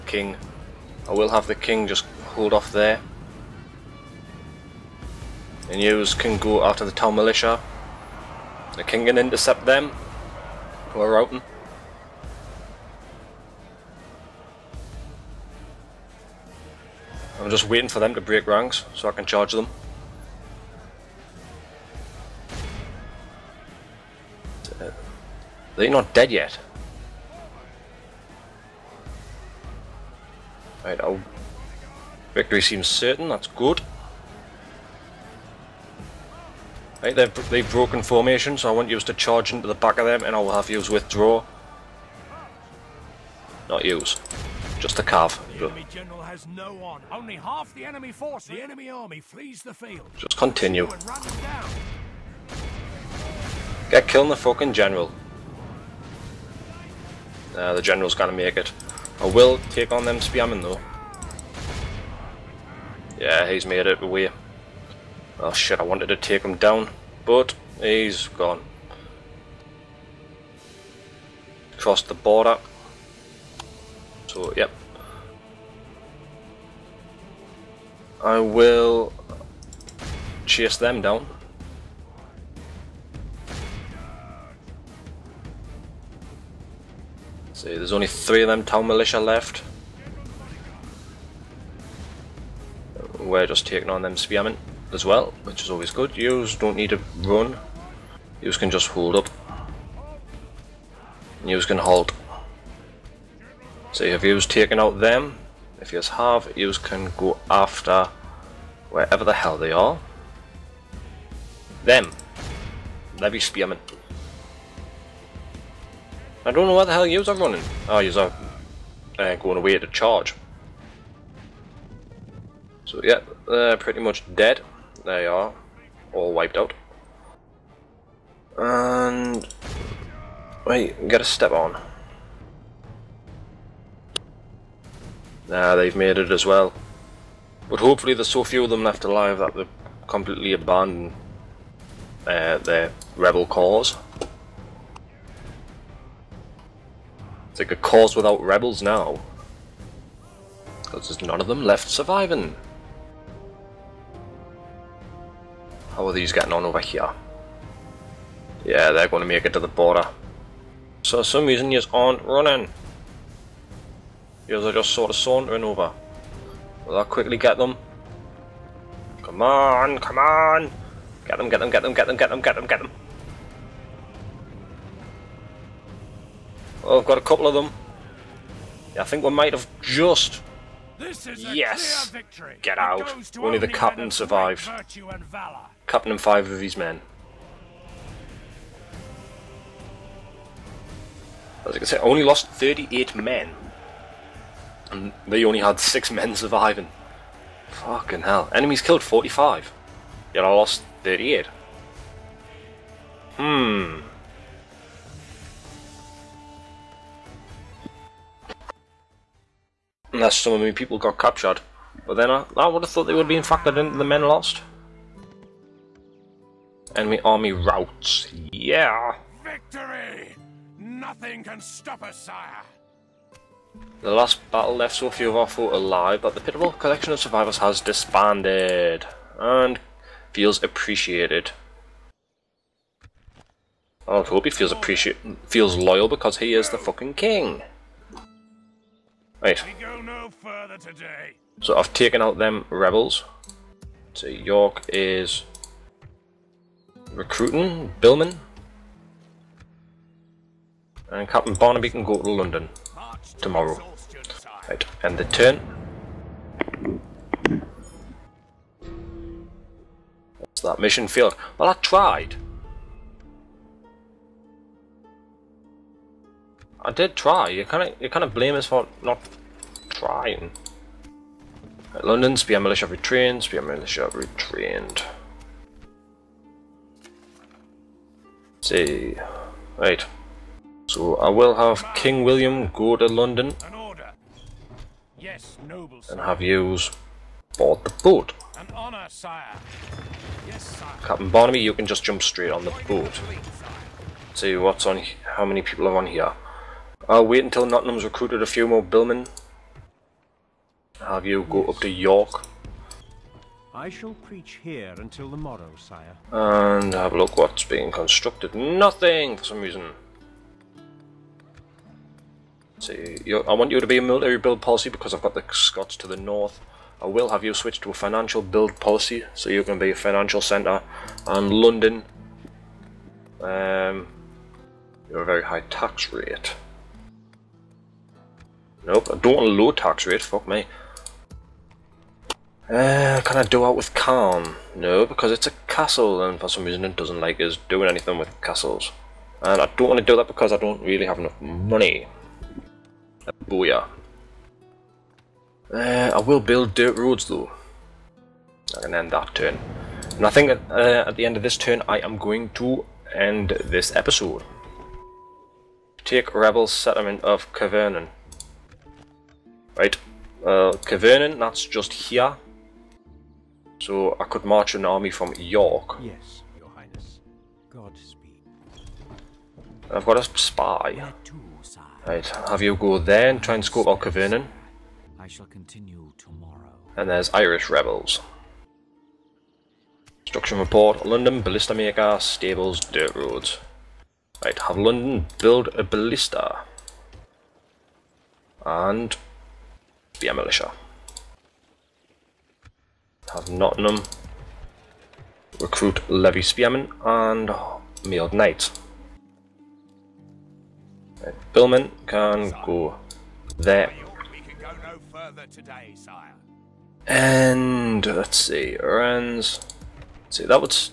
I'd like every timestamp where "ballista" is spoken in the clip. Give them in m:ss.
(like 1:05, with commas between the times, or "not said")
6:21, 6:25.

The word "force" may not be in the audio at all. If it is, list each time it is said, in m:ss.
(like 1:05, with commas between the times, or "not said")
0:48.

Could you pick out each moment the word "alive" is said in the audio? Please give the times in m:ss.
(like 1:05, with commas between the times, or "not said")
2:19, 3:45.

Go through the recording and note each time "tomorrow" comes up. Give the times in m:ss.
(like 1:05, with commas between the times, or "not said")
4:13, 6:16.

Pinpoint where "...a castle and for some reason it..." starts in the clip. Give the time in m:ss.
5:35.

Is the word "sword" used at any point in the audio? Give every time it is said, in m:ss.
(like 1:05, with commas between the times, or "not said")
not said.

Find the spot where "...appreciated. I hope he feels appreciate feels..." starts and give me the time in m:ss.
3:50.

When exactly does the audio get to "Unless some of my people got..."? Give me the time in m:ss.
3:30.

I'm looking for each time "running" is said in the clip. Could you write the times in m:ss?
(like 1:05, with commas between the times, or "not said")
1:57, 2:42.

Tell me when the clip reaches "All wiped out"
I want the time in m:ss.
2:06.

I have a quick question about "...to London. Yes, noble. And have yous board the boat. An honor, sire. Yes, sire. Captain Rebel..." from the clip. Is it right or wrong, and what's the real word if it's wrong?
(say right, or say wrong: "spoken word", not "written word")
wrong: "Barnaby", not "Rebel".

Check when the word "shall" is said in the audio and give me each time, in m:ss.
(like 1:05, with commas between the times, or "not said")
5:03, 6:15.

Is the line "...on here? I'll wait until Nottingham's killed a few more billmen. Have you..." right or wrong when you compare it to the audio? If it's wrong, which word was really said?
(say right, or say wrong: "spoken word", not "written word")
wrong: "recruited", not "killed".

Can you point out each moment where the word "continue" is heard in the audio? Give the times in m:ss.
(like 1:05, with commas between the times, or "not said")
0:50, 6:15.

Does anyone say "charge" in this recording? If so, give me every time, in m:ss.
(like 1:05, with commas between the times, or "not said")
0:19, 0:39, 1:59.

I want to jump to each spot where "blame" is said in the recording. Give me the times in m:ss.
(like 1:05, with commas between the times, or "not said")
4:28.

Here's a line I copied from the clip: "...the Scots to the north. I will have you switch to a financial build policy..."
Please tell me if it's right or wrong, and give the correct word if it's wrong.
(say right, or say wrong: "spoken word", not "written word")
right.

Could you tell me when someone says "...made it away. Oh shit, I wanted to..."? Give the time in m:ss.
1:03.